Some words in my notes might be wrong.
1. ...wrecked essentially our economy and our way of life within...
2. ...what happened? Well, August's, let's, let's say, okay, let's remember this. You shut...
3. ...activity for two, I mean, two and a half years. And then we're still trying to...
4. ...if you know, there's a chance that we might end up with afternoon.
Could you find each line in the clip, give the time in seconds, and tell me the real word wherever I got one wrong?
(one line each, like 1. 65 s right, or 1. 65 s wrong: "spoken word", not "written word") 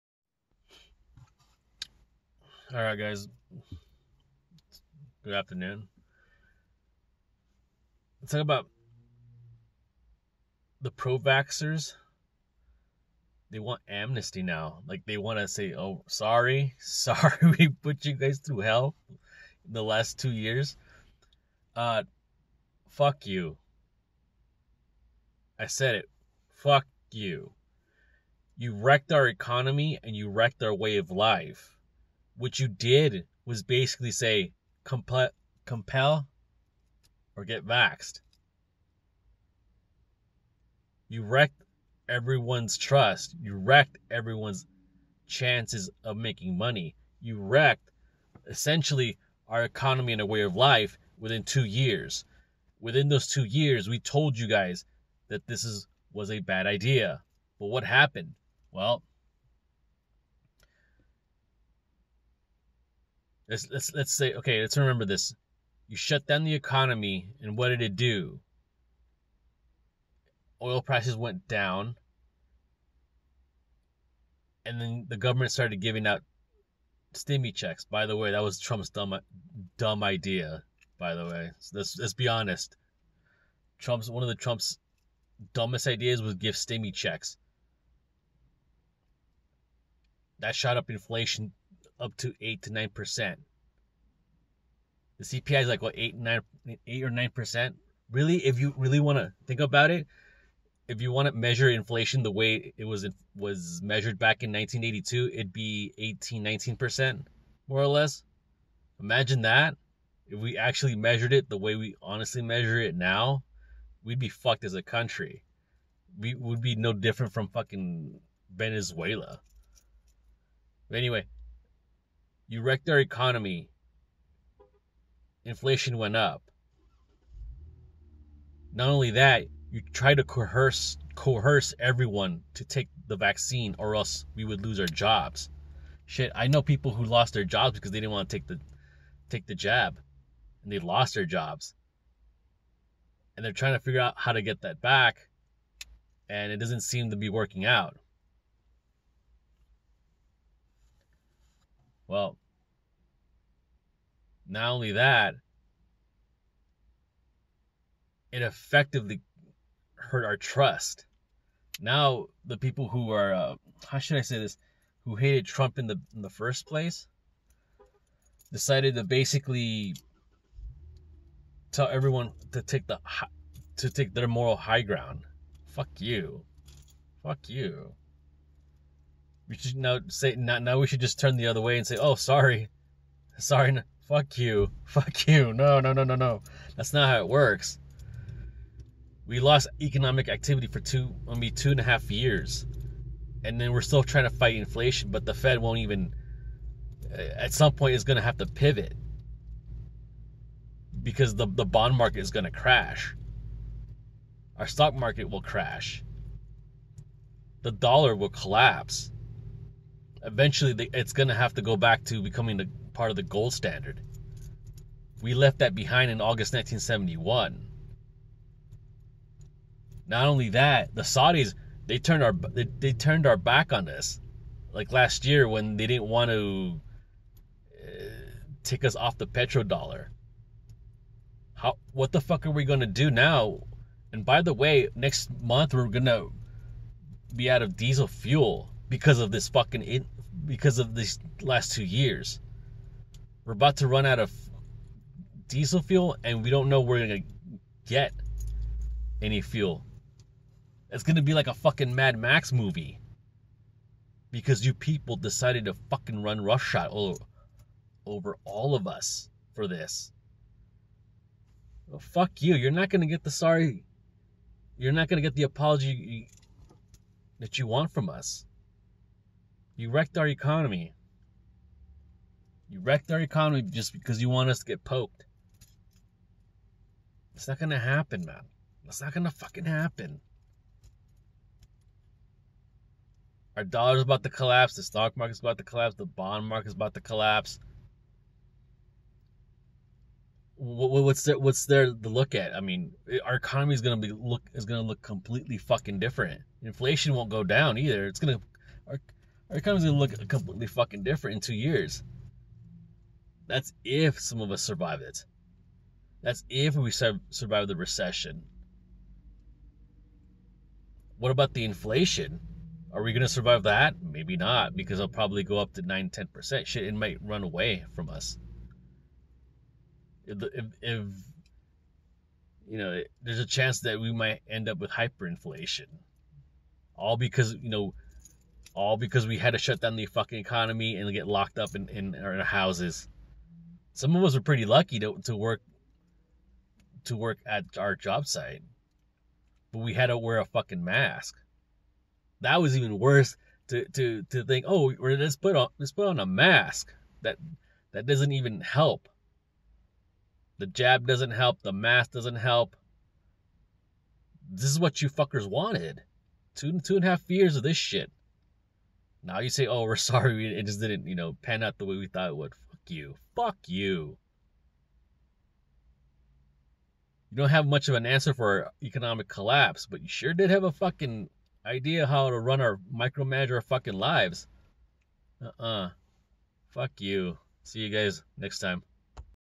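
1. 47 s right
2. 57 s wrong: "Let", not "August"
3. 190 s right
4. 320 s wrong: "hyperinflation", not "afternoon".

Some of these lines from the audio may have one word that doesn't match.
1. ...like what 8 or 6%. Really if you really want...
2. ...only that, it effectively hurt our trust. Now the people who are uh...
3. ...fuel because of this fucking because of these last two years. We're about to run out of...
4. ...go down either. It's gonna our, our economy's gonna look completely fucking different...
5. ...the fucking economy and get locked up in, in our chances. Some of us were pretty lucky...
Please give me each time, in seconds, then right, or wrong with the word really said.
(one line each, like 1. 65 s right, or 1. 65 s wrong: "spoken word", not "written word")
1. 95 s wrong: "9", not "6"
2. 154 s right
3. 238 s right
4. 297 s right
5. 329 s wrong: "houses", not "chances".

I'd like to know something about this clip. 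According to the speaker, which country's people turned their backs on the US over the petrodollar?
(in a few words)
Saudis.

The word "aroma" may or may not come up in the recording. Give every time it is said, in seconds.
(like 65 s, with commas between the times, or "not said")
not said.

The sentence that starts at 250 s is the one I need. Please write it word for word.
It's gonna be like a fucking Mad Max movie.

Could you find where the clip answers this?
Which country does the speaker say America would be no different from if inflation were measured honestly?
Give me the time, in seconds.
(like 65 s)
118 s.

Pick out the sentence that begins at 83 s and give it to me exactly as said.
Trump's one of the Trump's dumbest ideas was give stimmy checks.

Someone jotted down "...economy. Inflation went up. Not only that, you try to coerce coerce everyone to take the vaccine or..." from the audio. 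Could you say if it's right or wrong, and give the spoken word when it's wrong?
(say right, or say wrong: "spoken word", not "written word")
right.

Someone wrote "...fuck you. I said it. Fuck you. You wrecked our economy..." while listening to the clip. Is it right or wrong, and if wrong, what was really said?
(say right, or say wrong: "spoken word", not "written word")
right.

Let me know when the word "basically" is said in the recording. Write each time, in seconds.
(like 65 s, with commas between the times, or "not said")
33 s, 169 s.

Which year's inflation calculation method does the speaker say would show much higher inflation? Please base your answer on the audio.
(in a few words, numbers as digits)
1982.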